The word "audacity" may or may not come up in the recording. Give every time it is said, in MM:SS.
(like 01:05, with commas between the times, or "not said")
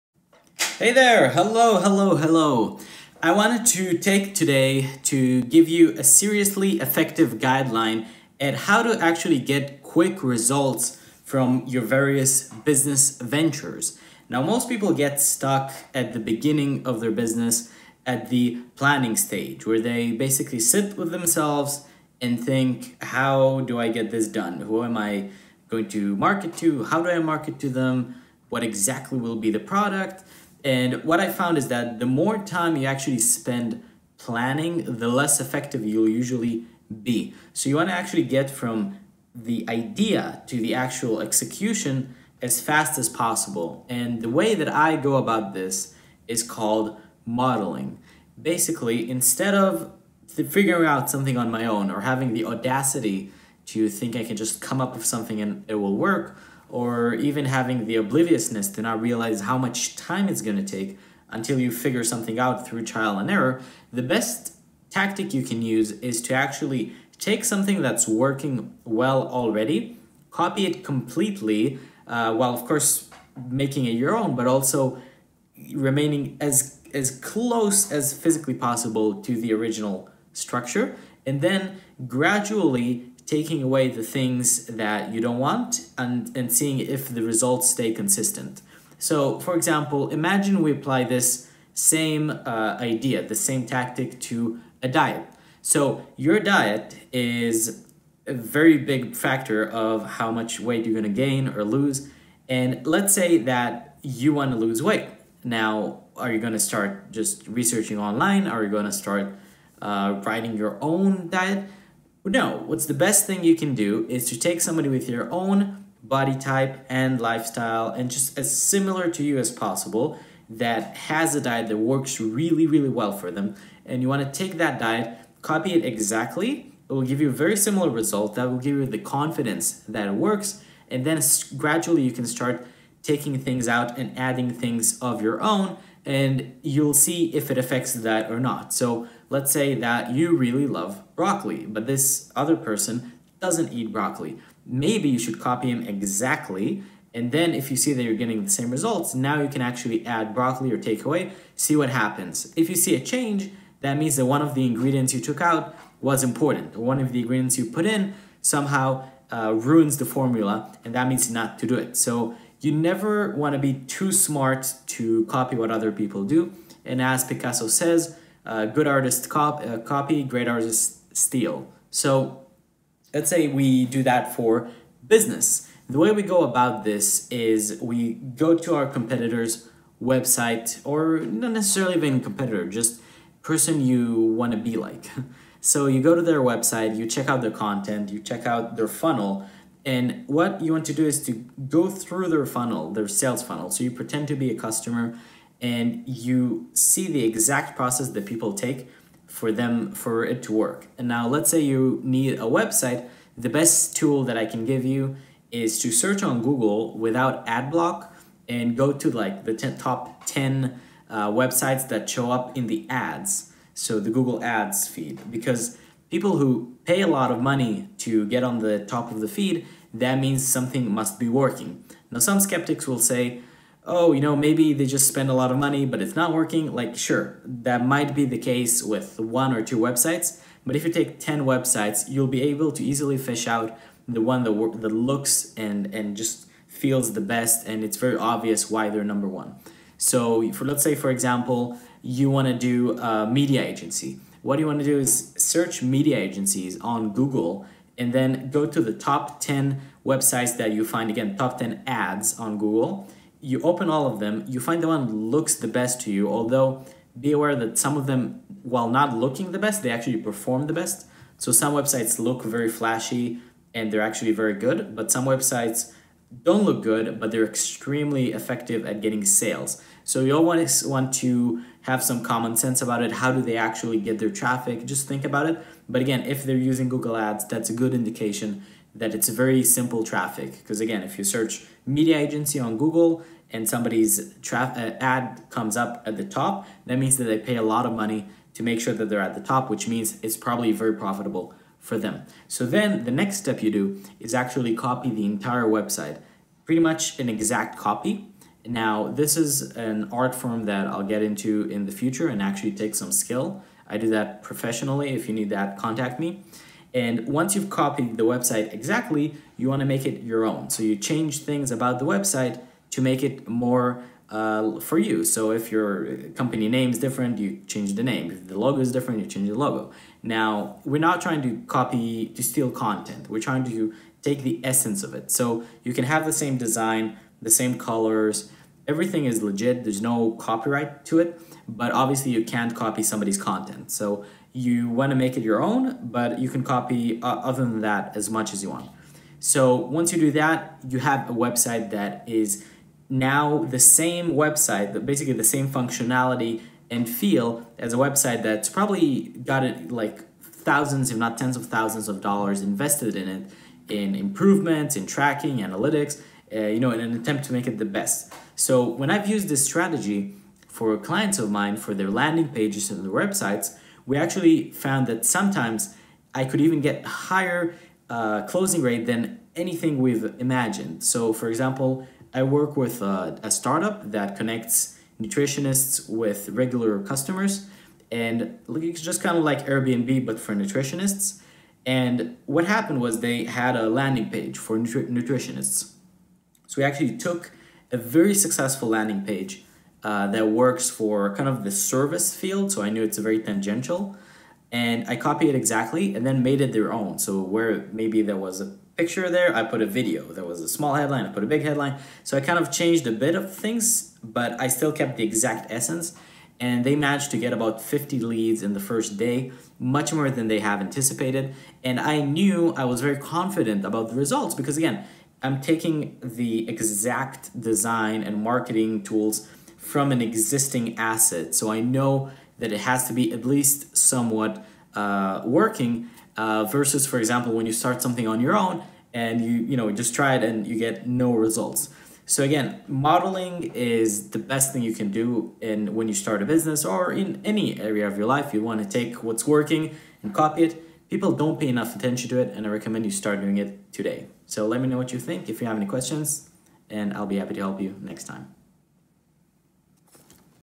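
00:52.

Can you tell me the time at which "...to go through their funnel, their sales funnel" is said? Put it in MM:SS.
03:11.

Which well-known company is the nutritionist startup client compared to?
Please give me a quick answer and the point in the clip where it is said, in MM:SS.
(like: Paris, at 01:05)
Airbnb, at 06:19.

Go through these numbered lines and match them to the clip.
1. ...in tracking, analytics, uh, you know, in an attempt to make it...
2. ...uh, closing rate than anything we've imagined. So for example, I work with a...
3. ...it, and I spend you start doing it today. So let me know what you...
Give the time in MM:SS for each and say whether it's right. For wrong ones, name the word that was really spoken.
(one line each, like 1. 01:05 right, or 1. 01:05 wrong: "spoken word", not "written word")
1. 05:54 right
2. 06:08 right
3. 07:22 wrong: "recommend", not "spend".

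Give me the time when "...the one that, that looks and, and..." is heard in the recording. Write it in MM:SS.
03:54.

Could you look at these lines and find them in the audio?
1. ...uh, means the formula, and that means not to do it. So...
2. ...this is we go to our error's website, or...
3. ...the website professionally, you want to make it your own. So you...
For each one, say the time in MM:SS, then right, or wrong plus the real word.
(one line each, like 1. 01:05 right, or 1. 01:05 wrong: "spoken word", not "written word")
1. 02:39 wrong: "ruins", not "means"
2. 02:56 wrong: "competitor", not "error"
3. 05:08 wrong: "exactly", not "professionally".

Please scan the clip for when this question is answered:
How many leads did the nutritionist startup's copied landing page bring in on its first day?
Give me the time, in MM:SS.
06:47.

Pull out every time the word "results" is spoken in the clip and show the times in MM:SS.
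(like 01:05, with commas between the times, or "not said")
00:10, 01:27, 02:07, 02:28, 06:54, 07:11.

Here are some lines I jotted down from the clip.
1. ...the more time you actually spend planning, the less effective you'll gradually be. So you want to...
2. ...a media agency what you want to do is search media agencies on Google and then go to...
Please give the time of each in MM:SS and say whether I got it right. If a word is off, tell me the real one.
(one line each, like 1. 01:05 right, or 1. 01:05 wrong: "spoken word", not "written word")
1. 00:31 wrong: "usually", not "gradually"
2. 04:02 right.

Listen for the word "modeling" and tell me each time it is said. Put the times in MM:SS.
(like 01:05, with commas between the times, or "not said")
00:47, 07:12.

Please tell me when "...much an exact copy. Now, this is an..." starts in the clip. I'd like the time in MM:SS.
04:56.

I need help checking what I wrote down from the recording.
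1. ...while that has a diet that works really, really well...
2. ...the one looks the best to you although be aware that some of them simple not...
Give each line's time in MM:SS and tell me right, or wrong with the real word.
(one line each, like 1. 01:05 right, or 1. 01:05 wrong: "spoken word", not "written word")
1. 01:59 wrong: "possible", not "while"
2. 04:14 wrong: "while", not "simple".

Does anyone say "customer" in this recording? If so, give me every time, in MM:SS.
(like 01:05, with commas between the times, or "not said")
03:14, 06:17.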